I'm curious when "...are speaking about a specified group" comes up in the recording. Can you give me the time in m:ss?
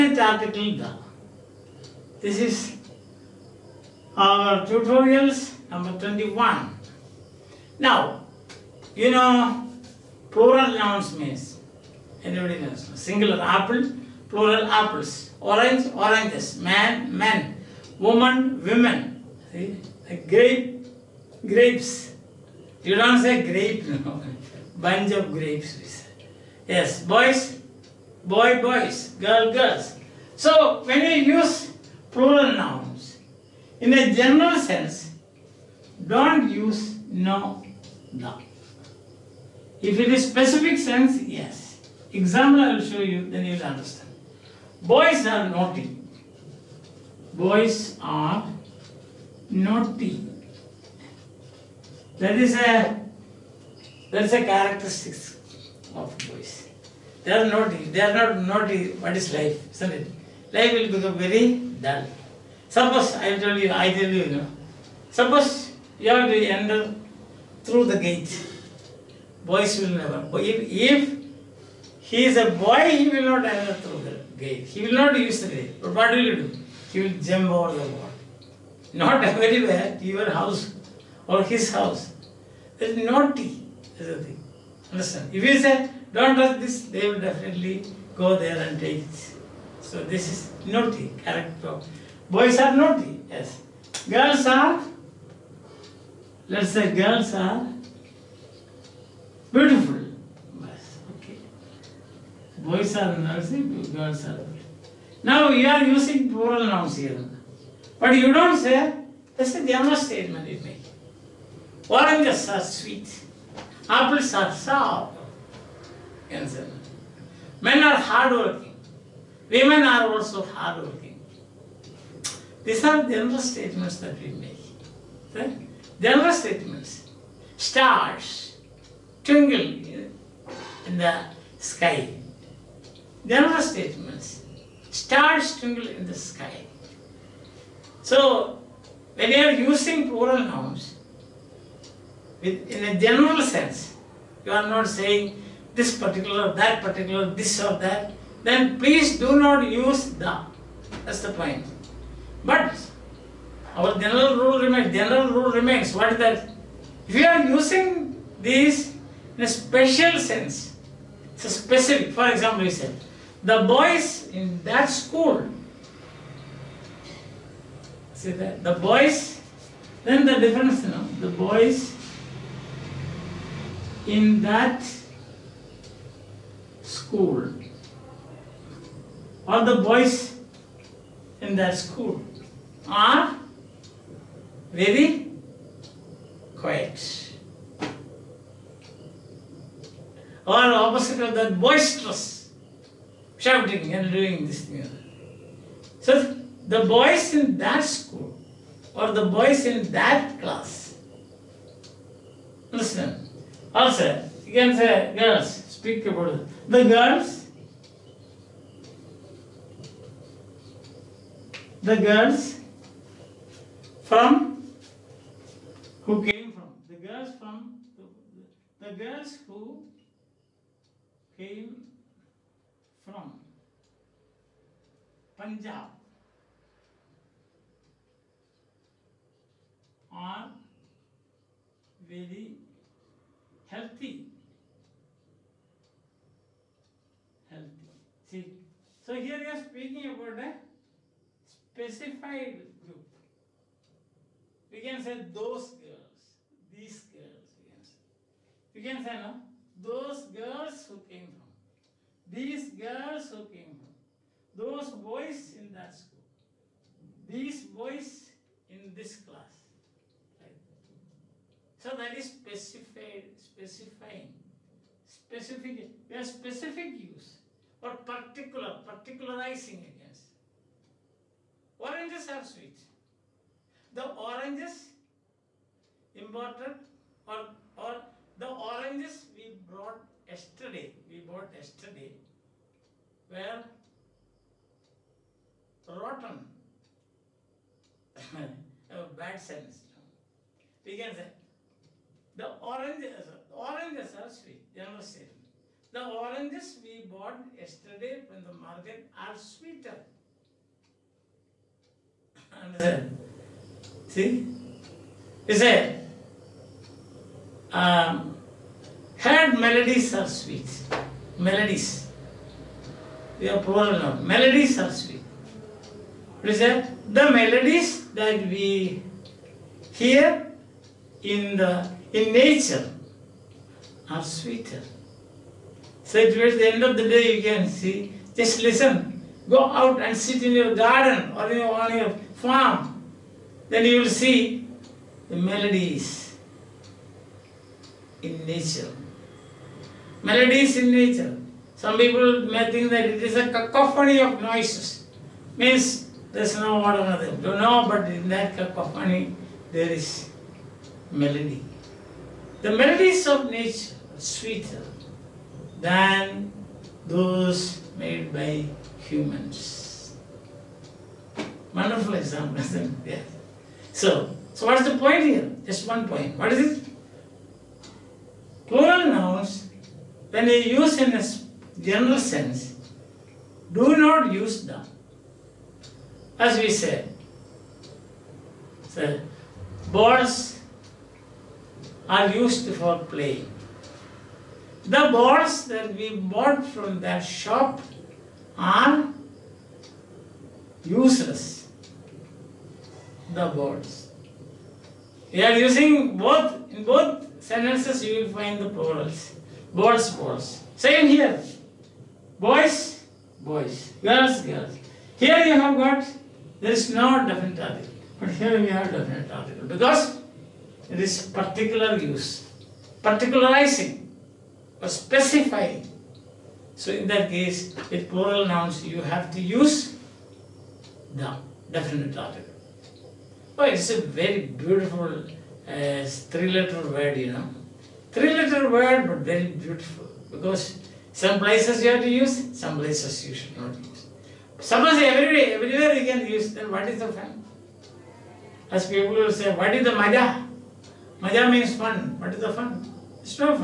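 3:59.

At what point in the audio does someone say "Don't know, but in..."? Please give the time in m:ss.
5:47.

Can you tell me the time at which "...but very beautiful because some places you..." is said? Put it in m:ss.
7:09.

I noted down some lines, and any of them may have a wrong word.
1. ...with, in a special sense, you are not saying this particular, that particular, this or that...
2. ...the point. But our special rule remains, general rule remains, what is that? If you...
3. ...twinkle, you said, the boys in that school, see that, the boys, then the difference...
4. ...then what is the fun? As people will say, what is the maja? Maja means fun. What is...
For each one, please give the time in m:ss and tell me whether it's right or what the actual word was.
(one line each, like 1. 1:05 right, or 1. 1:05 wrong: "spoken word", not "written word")
1. 2:22 wrong: "general", not "special"
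2. 2:31 wrong: "general", not "special"
3. 2:42 wrong: "example", not "twinkle"
4. 7:16 right.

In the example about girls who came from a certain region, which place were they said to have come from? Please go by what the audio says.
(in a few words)
Punjab.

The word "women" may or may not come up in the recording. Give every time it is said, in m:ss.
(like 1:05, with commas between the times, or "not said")
0:18, 1:59.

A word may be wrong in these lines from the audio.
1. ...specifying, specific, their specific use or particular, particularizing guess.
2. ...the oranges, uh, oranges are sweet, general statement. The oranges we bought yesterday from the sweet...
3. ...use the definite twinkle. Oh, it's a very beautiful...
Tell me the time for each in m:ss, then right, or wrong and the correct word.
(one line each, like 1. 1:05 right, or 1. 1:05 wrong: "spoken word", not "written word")
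1. 4:23 right
2. 4:52 wrong: "market", not "sweet"
3. 6:59 wrong: "article", not "twinkle".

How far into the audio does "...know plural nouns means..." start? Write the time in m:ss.
0:09.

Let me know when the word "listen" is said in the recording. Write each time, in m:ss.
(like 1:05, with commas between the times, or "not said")
3:22, 5:28.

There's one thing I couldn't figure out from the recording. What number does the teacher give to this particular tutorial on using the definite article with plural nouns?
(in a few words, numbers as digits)
21.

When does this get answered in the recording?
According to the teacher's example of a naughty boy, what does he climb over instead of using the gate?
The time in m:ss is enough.
1:17.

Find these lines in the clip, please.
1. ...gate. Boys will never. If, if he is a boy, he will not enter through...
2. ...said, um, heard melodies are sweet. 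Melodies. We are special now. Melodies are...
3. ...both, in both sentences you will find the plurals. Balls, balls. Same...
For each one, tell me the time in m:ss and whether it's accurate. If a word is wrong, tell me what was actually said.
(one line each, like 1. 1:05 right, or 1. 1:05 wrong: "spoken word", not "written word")
1. 1:08 right
2. 5:05 wrong: "plural", not "special"
3. 6:36 right.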